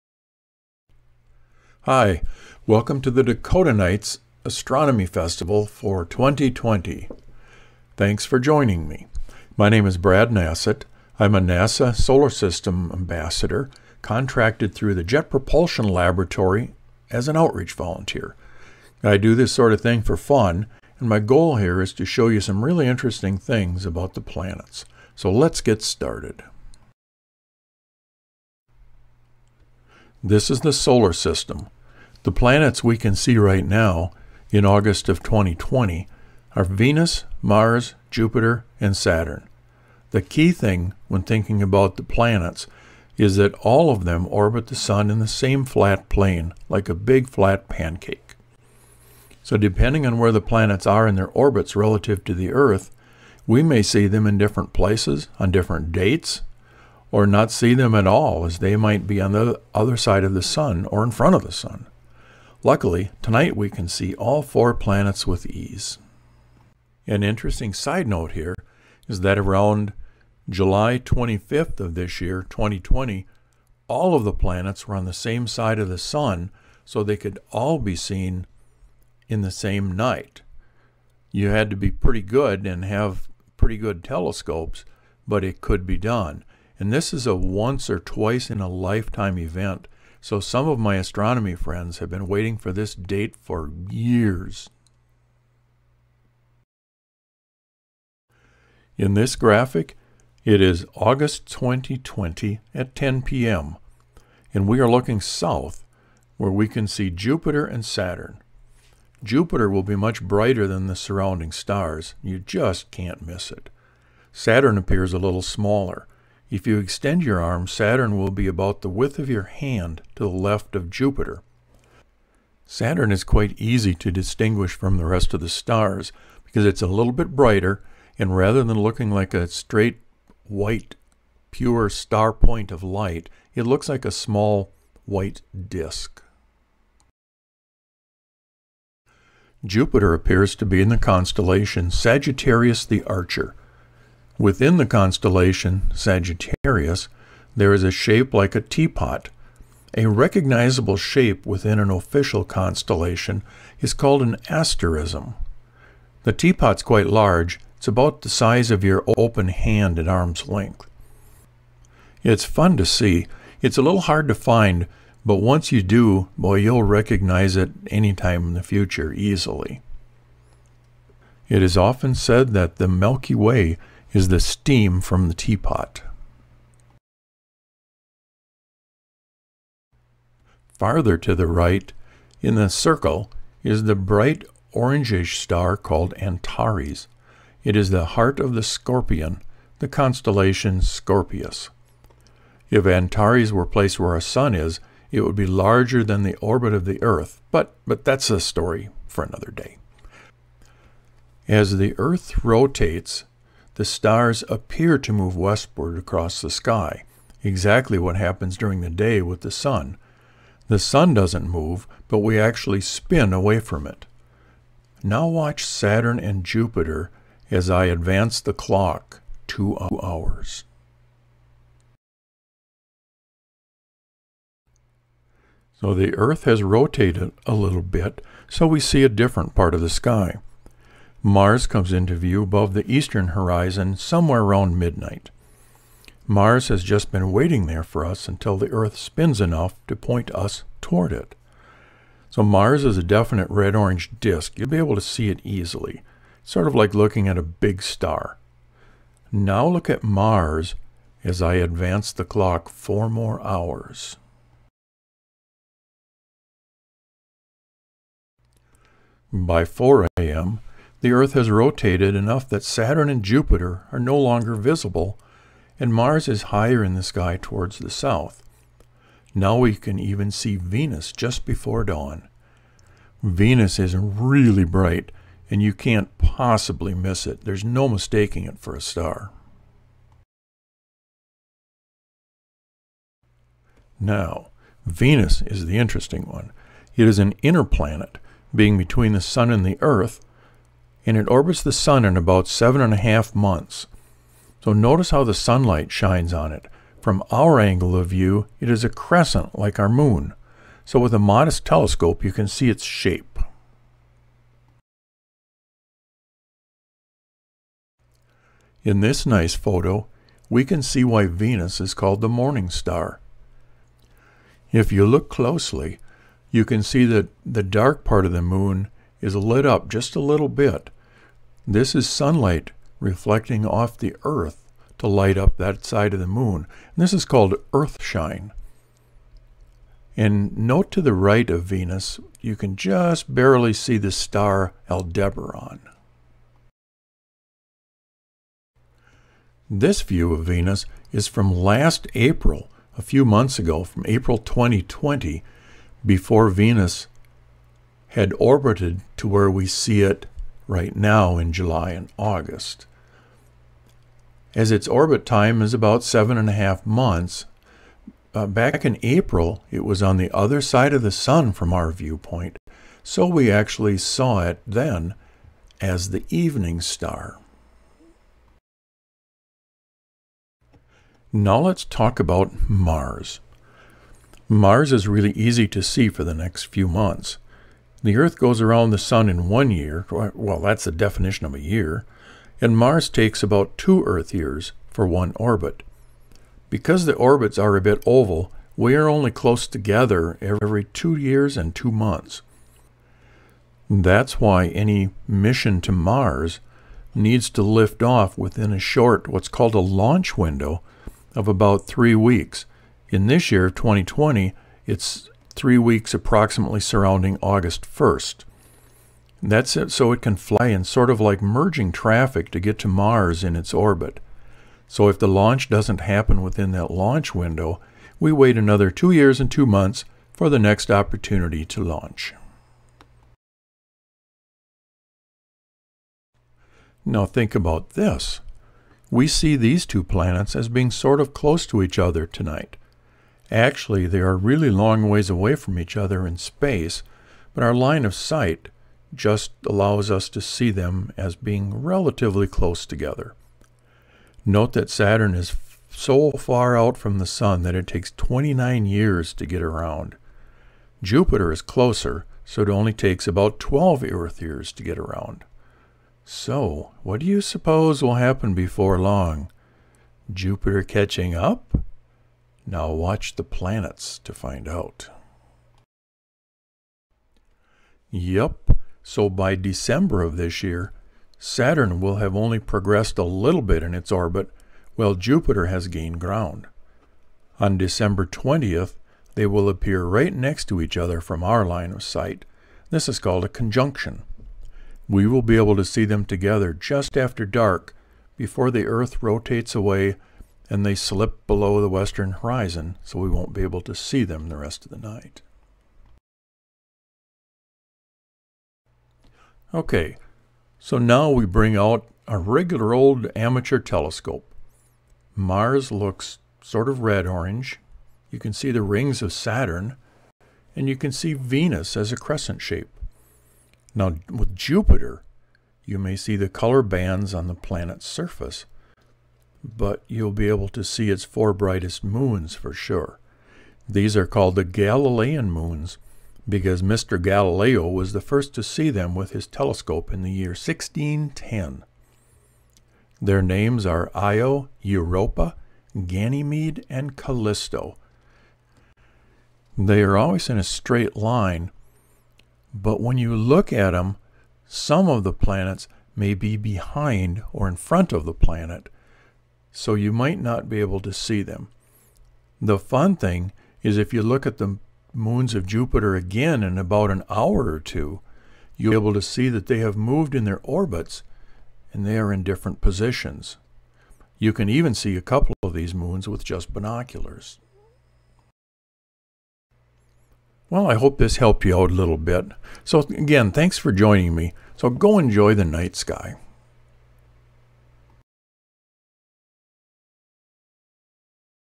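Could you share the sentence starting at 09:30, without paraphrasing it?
Well, I hope this helped you out a little bit.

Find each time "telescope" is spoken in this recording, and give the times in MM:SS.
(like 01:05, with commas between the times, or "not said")
01:24, 05:01, 08:23, 08:49.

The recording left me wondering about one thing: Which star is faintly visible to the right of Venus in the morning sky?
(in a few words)
Aldebaran.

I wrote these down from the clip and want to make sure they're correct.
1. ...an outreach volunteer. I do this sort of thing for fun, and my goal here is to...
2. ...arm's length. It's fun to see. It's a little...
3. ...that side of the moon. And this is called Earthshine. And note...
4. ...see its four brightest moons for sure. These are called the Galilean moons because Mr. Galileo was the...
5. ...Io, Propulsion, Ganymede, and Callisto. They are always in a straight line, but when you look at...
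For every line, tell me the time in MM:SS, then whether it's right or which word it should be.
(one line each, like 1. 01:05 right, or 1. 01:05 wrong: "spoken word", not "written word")
1. 00:17 right
2. 02:40 right
3. 05:25 right
4. 08:40 right
5. 08:54 wrong: "Europa", not "Propulsion".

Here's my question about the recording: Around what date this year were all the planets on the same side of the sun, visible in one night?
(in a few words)
July 25th.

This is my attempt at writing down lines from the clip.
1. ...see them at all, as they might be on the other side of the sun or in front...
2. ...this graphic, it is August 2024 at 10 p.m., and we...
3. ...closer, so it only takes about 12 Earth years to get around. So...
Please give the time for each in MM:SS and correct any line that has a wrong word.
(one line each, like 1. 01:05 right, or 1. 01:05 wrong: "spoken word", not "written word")
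1. 00:57 right
2. 01:39 wrong: "2020", not "2024"
3. 07:31 right.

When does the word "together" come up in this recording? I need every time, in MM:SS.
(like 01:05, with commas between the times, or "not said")
06:29, 07:22, 08:06.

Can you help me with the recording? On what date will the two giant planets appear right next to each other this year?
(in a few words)
December 20th.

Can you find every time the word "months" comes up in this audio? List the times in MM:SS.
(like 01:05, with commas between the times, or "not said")
04:53, 05:43, 05:56, 06:16, 06:31, 06:59.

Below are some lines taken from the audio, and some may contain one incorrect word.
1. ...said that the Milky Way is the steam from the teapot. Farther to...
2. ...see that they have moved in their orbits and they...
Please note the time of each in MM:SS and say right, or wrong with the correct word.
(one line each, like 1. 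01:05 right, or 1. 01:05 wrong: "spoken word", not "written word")
1. 02:52 right
2. 09:19 right.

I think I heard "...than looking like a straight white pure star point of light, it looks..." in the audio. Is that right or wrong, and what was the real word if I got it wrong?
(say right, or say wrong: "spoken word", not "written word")
right.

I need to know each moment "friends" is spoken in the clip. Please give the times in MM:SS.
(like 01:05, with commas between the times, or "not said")
01:31.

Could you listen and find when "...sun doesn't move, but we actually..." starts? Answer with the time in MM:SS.
03:30.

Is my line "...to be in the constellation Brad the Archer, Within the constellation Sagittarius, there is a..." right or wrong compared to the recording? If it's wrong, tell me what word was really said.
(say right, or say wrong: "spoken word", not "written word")
wrong: "Sagittarius", not "Brad".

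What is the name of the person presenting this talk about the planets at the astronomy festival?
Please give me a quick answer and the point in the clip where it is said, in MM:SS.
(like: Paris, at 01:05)
Brad Nasset, at 00:09.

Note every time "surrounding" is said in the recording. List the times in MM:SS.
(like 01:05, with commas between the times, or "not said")
01:50, 06:46.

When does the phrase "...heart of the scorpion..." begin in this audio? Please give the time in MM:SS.
03:08.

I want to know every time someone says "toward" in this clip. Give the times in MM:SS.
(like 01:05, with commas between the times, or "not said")
04:00, 04:27.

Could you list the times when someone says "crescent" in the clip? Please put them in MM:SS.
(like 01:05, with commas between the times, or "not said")
04:58, 08:32.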